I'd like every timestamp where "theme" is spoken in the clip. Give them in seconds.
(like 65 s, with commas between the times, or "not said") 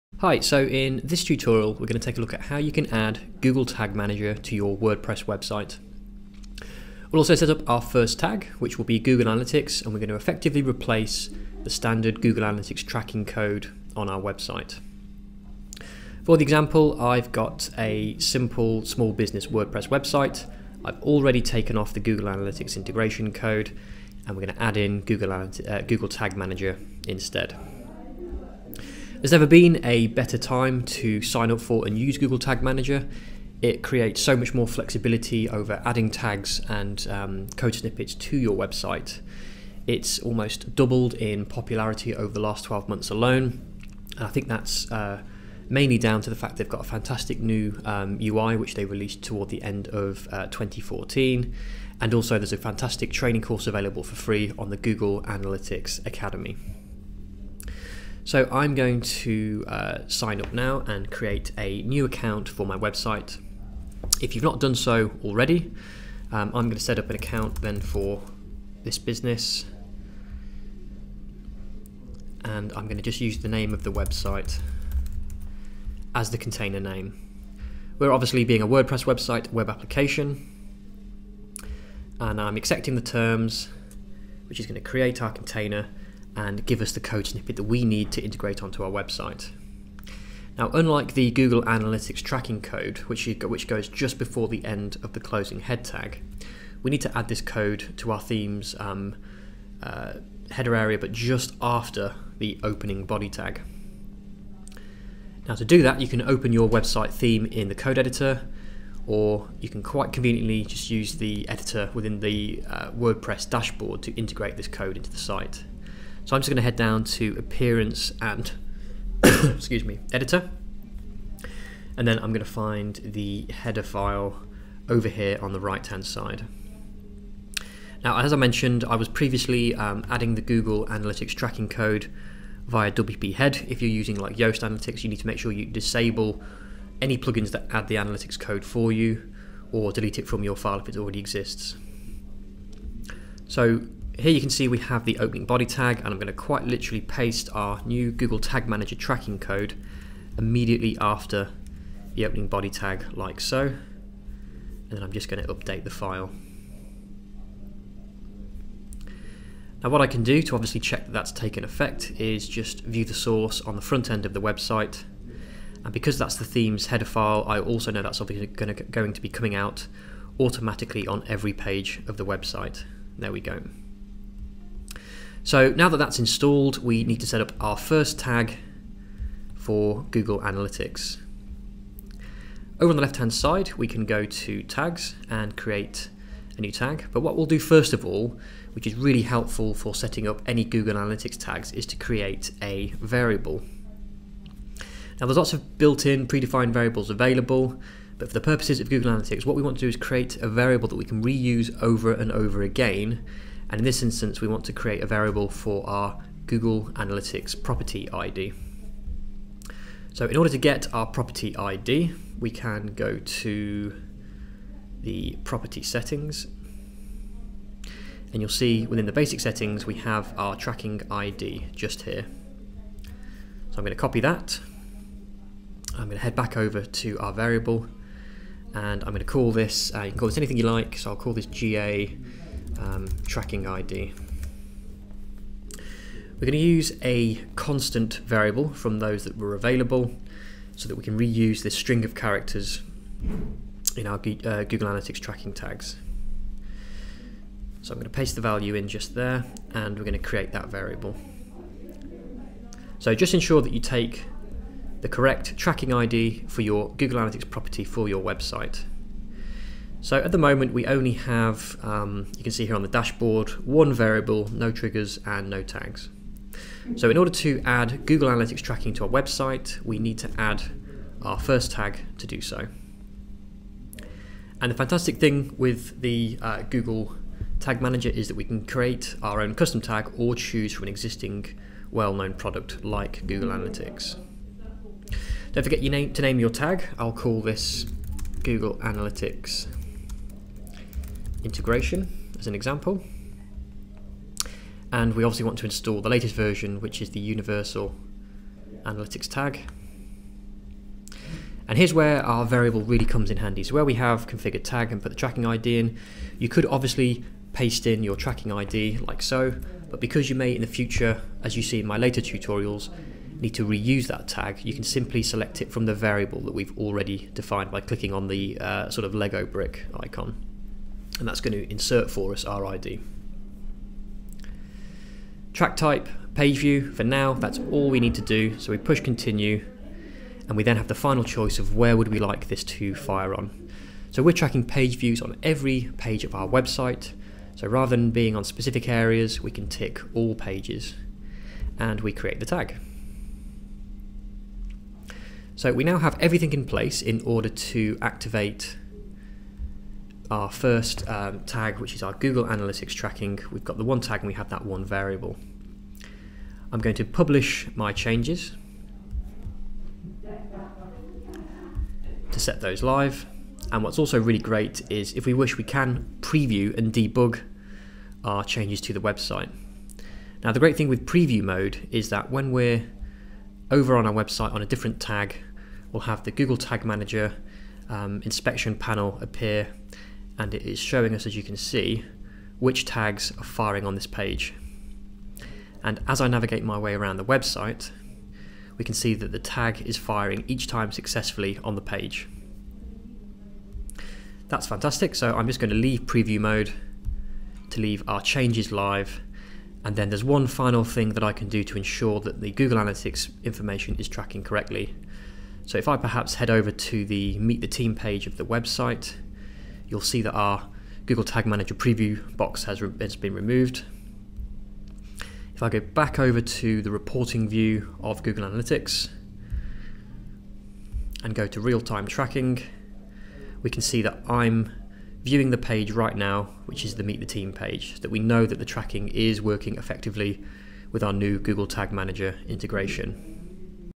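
98 s, 107 s, 166 s.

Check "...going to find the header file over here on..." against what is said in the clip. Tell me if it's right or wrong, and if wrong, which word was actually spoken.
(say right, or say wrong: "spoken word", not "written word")
right.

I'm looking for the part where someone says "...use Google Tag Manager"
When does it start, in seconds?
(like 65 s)
31 s.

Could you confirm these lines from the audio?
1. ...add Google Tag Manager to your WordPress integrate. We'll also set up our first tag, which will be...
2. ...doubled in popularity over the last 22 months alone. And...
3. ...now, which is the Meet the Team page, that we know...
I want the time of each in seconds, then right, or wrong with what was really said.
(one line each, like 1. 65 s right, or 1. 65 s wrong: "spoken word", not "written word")
1. 2 s wrong: "website", not "integrate"
2. 40 s wrong: "12", not "22"
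3. 426 s right.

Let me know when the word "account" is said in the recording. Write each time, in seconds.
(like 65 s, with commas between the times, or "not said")
62 s, 67 s.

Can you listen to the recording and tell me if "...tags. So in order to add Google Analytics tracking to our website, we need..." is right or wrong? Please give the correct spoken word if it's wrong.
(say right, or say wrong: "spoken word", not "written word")
right.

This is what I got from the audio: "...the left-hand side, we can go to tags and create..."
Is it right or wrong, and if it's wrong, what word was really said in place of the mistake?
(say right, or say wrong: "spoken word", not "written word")
right.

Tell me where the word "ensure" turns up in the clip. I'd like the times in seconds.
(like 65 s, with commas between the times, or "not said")
253 s, 401 s.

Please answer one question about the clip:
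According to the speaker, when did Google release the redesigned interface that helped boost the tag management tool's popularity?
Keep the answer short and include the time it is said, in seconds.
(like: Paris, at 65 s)
end of 2014, at 49 s.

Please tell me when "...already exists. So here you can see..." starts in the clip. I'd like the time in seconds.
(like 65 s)
140 s.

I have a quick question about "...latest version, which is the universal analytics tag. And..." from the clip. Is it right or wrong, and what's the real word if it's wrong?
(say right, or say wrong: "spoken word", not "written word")
right.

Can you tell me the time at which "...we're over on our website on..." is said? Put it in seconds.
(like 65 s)
372 s.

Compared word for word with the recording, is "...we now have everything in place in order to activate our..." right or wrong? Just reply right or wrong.
right.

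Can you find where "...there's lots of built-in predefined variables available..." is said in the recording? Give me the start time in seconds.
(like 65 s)
195 s.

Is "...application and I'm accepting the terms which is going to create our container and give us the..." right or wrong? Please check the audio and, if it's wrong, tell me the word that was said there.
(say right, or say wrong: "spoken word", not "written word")
right.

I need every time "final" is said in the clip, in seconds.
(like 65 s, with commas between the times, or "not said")
330 s, 400 s.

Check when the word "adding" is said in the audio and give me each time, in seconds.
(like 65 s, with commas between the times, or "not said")
35 s, 130 s.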